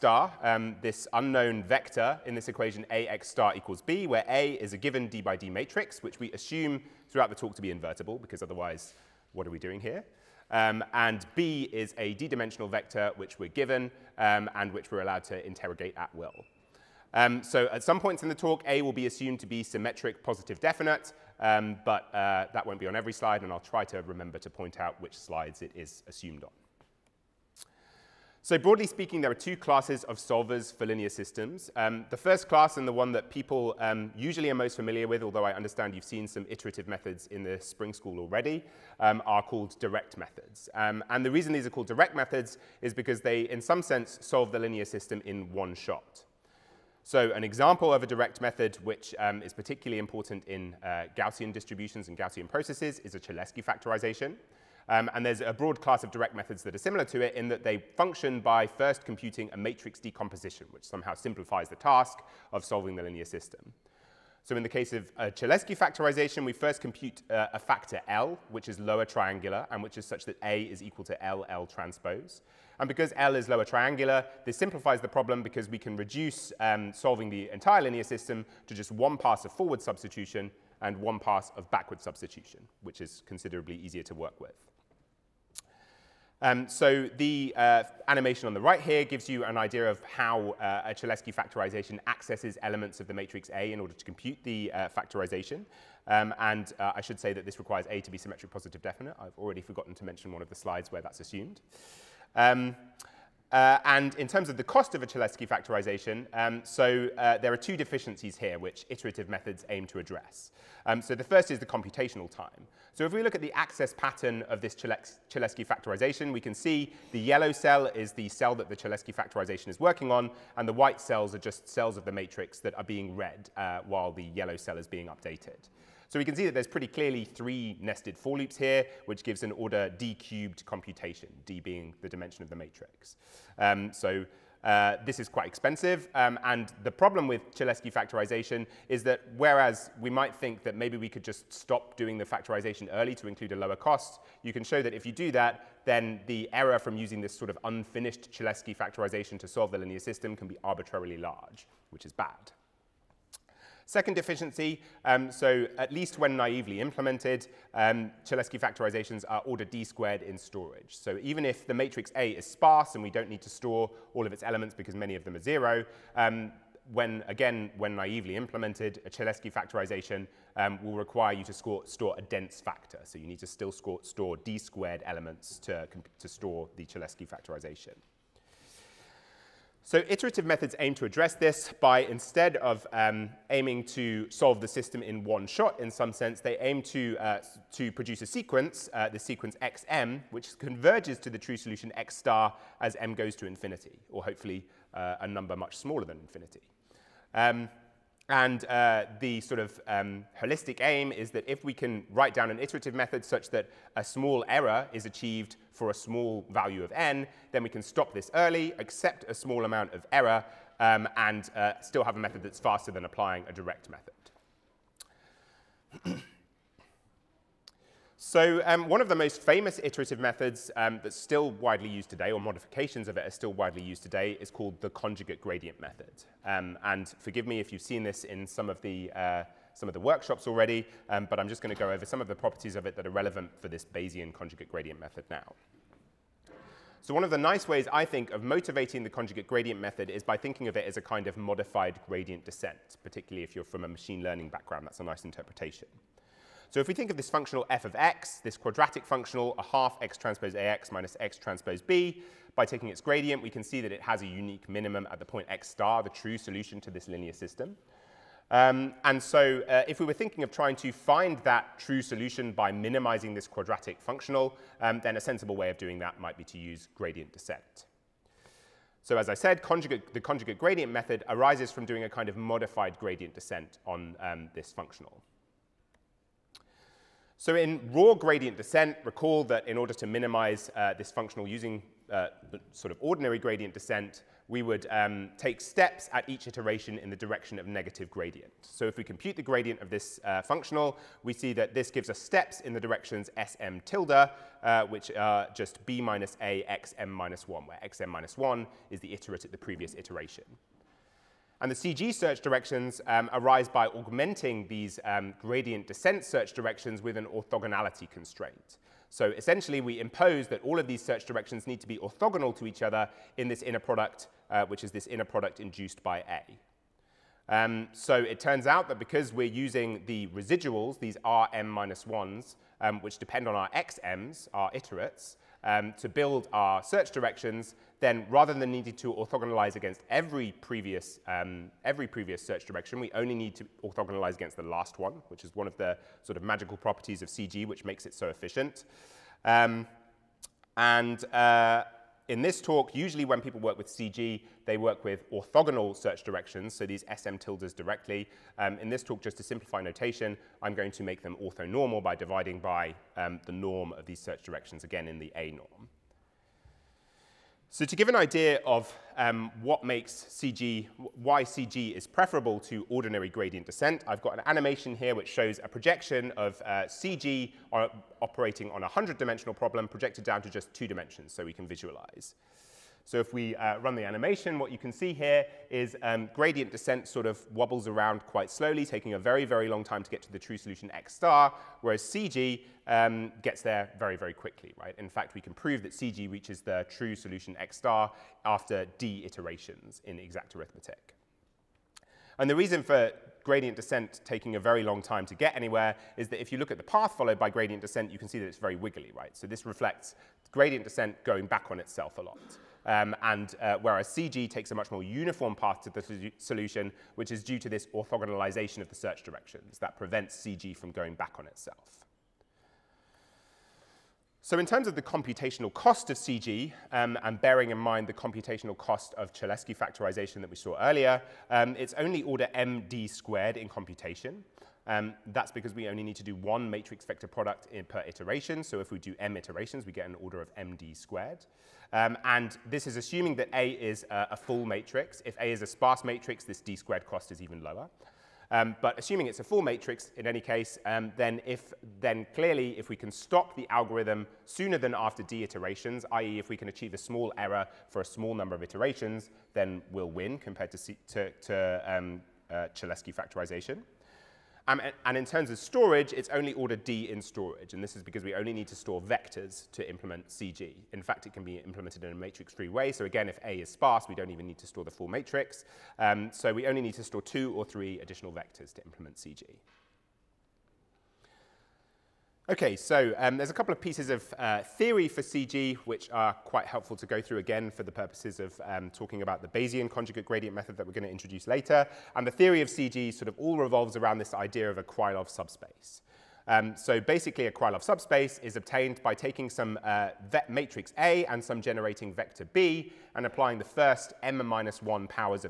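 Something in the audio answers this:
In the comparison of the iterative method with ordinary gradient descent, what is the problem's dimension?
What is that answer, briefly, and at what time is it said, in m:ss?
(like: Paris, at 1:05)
100, at 6:08.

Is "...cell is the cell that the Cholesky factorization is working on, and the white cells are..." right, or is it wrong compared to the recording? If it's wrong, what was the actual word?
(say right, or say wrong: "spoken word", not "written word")
right.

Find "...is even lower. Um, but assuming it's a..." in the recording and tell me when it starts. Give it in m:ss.
7:17.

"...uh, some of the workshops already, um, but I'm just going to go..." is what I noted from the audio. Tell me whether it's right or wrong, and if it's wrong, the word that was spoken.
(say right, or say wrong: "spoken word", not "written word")
right.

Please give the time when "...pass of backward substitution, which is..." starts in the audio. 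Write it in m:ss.
1:21.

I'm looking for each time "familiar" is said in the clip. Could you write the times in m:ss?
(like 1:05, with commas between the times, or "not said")
0:34.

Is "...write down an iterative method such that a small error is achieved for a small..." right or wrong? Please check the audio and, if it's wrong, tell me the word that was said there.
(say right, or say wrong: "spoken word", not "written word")
right.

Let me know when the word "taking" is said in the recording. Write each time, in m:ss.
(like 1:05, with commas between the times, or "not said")
4:12, 6:18, 6:34, 8:09.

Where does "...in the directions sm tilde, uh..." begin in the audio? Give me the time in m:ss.
4:52.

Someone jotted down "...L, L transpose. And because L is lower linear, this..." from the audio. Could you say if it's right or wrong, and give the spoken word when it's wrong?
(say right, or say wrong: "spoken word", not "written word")
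wrong: "triangular", not "linear".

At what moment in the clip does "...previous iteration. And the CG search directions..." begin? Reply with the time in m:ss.
4:59.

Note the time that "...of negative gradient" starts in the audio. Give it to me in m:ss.
4:47.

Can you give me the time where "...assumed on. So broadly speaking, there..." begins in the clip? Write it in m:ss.
0:26.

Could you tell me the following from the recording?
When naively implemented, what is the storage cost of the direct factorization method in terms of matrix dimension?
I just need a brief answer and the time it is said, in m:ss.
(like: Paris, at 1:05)
order d squared, at 2:39.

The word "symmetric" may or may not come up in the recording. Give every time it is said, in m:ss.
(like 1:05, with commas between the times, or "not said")
0:19, 1:38.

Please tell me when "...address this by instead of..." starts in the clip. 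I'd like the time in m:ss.
3:01.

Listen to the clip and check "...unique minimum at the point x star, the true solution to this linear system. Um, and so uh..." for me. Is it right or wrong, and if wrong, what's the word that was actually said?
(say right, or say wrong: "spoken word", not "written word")
right.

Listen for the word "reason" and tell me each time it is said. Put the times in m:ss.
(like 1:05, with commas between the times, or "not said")
0:41, 6:32.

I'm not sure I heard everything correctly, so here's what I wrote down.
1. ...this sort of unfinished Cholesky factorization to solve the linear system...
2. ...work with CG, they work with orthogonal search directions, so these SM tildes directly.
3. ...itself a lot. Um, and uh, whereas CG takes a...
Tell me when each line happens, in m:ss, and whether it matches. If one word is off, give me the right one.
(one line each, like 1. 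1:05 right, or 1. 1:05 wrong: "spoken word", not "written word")
1. 2:27 right
2. 5:43 right
3. 6:41 right.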